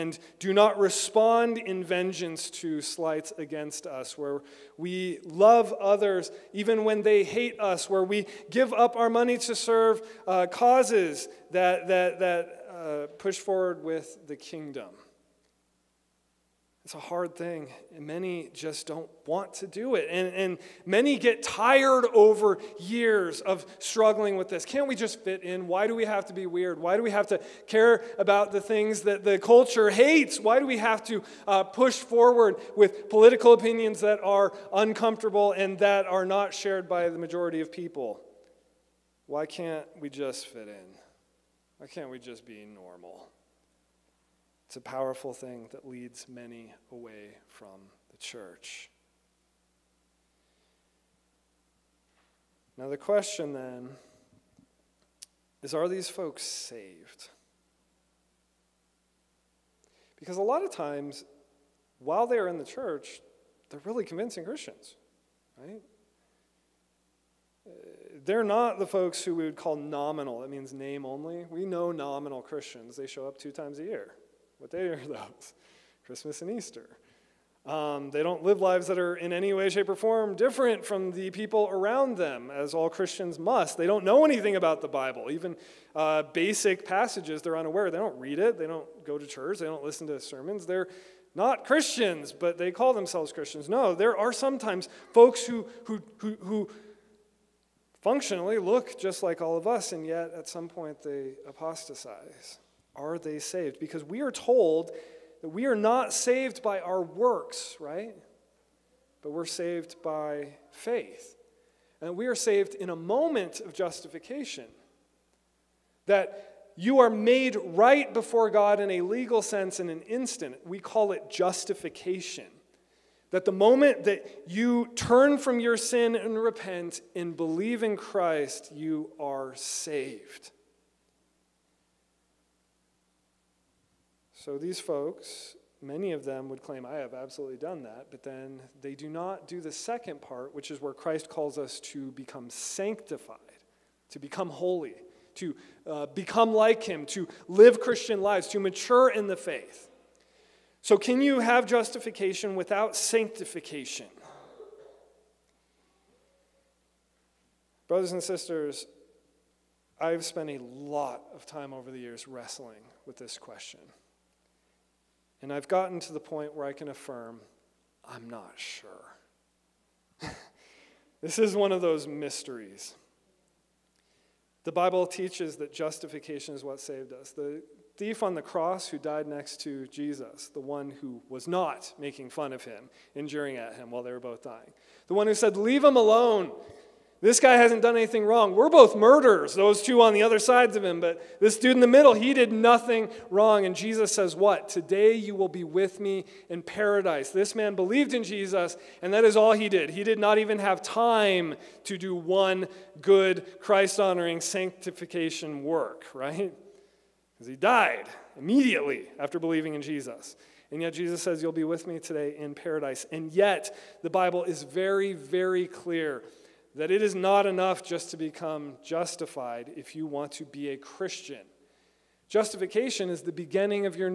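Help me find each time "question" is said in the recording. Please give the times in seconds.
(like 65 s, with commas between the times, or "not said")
52 s, 163 s.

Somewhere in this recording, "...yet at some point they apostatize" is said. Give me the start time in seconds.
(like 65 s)
100 s.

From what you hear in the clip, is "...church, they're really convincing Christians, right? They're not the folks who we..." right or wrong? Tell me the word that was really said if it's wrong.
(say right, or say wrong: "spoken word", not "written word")
right.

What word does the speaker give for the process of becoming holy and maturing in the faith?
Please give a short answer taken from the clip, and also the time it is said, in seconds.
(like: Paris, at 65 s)
sanctified, at 142 s.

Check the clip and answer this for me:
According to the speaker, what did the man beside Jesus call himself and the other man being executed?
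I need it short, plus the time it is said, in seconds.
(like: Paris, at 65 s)
murderers, at 188 s.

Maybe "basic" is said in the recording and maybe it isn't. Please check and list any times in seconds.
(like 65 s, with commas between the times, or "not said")
86 s.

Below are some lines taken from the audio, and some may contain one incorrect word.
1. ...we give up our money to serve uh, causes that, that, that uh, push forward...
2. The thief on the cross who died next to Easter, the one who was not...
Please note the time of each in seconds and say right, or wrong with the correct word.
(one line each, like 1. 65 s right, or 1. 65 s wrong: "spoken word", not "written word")
1. 8 s right
2. 177 s wrong: "Jesus", not "Easter".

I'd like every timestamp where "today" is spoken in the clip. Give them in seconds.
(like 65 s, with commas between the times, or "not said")
194 s, 211 s.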